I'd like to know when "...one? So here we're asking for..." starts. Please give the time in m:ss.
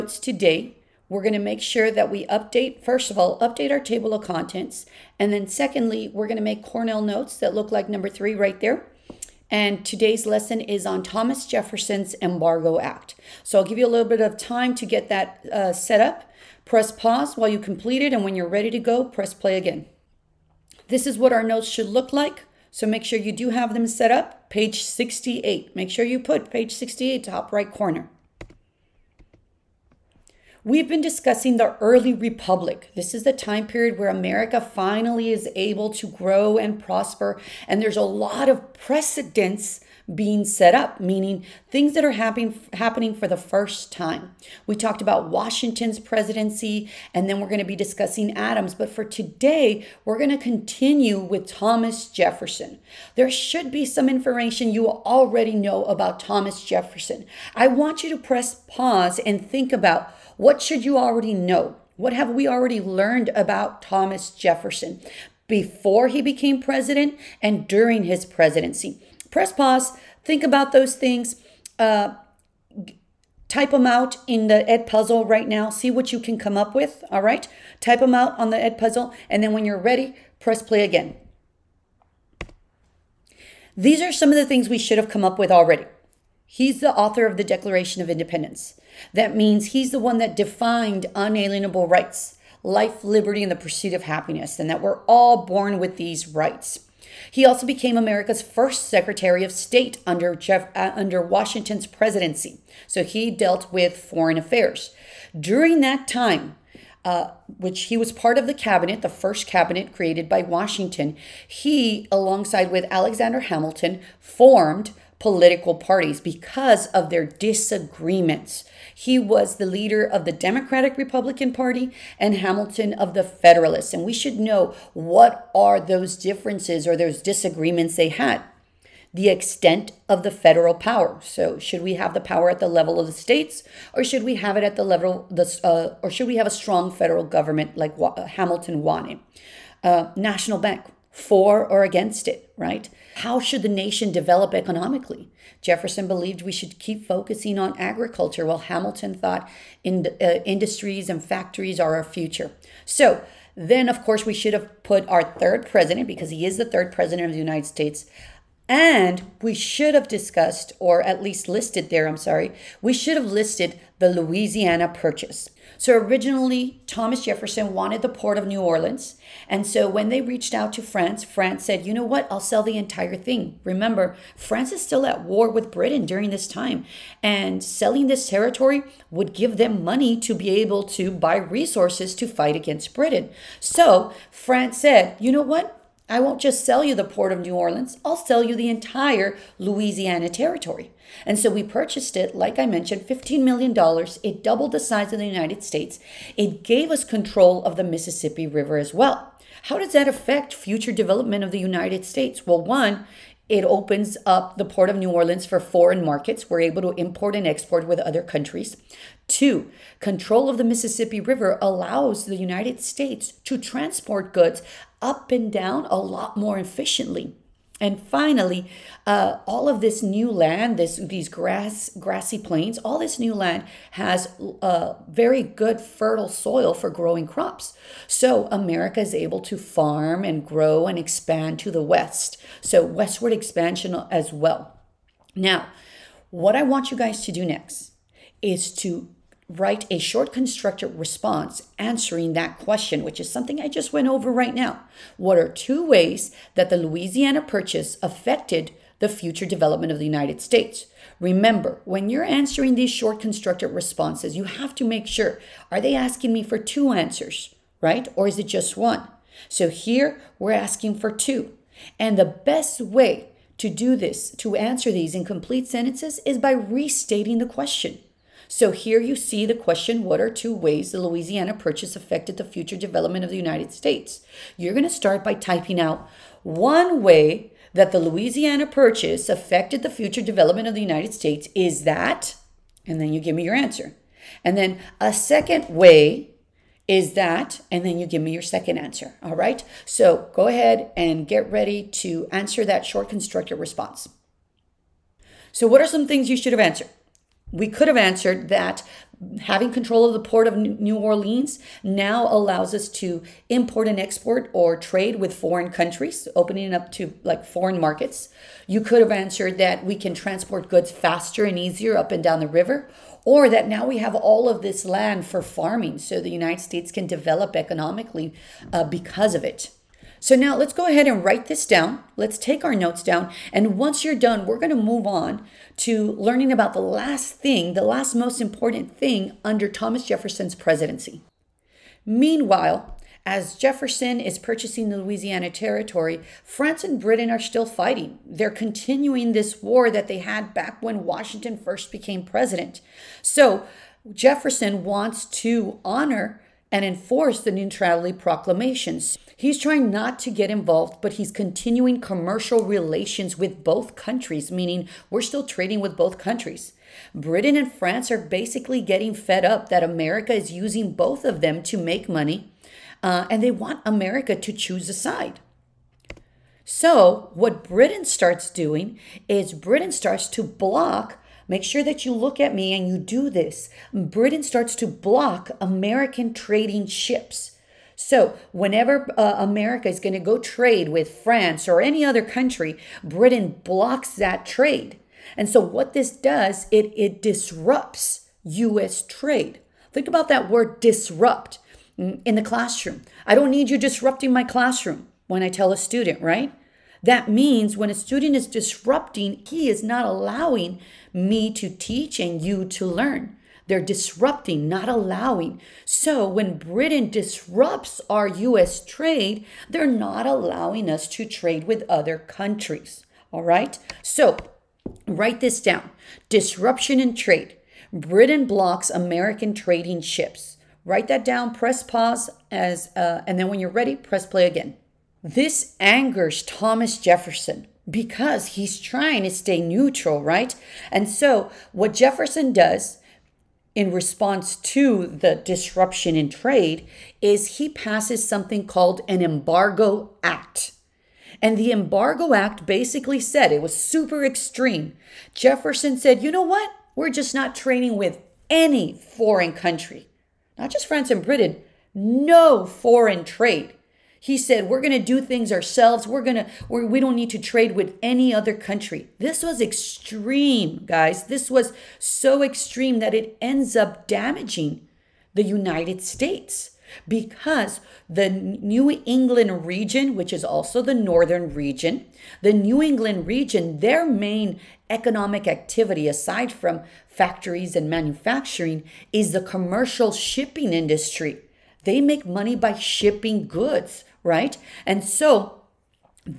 4:18.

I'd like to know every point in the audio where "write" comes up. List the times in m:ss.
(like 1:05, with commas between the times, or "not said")
3:59, 5:21, 6:55, 7:00.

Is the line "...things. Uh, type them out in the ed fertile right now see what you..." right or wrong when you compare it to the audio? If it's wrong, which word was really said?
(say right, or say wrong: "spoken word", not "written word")
wrong: "puzzle", not "fertile".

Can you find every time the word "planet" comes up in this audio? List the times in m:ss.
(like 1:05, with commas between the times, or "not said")
not said.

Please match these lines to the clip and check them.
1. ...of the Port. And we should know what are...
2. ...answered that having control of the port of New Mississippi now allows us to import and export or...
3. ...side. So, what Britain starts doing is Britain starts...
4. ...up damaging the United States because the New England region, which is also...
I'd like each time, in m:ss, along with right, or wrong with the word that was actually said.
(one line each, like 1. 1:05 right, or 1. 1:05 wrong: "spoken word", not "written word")
1. 2:02 wrong: "Federalists", not "Port"
2. 4:57 wrong: "Orleans", not "Mississippi"
3. 6:04 right
4. 7:43 right.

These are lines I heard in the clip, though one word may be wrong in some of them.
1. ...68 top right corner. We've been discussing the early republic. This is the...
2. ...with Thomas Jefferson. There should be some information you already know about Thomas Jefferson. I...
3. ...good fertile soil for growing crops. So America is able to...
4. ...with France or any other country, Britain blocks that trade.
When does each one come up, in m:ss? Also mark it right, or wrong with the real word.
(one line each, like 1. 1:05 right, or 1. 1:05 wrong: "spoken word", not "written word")
1. 0:26 right
2. 0:51 right
3. 3:45 right
4. 6:20 right.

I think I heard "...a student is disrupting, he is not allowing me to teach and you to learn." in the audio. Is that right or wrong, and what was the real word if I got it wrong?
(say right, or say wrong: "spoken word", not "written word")
right.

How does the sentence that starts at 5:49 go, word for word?
He's trying not to get involved, but he's continuing commercial relations with both countries, meaning we're still trading with both countries.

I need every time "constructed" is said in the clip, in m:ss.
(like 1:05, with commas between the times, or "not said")
4:00, 4:13, 4:53.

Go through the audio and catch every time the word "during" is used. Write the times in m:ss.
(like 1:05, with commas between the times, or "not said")
1:07, 1:45, 2:56.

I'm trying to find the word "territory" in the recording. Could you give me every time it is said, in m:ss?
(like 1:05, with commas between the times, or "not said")
2:58, 3:10, 5:35.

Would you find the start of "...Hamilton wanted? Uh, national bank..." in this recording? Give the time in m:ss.
2:18.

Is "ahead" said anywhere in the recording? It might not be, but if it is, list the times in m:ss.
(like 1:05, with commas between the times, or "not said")
4:50, 5:20.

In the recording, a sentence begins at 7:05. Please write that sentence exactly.
This angers Thomas Jefferson because he's trying to stay neutral, right?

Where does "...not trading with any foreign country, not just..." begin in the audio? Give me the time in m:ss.
7:27.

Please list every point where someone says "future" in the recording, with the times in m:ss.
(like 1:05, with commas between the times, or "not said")
2:32, 3:20, 4:09, 4:32, 4:39.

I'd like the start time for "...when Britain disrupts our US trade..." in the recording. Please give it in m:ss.
6:46.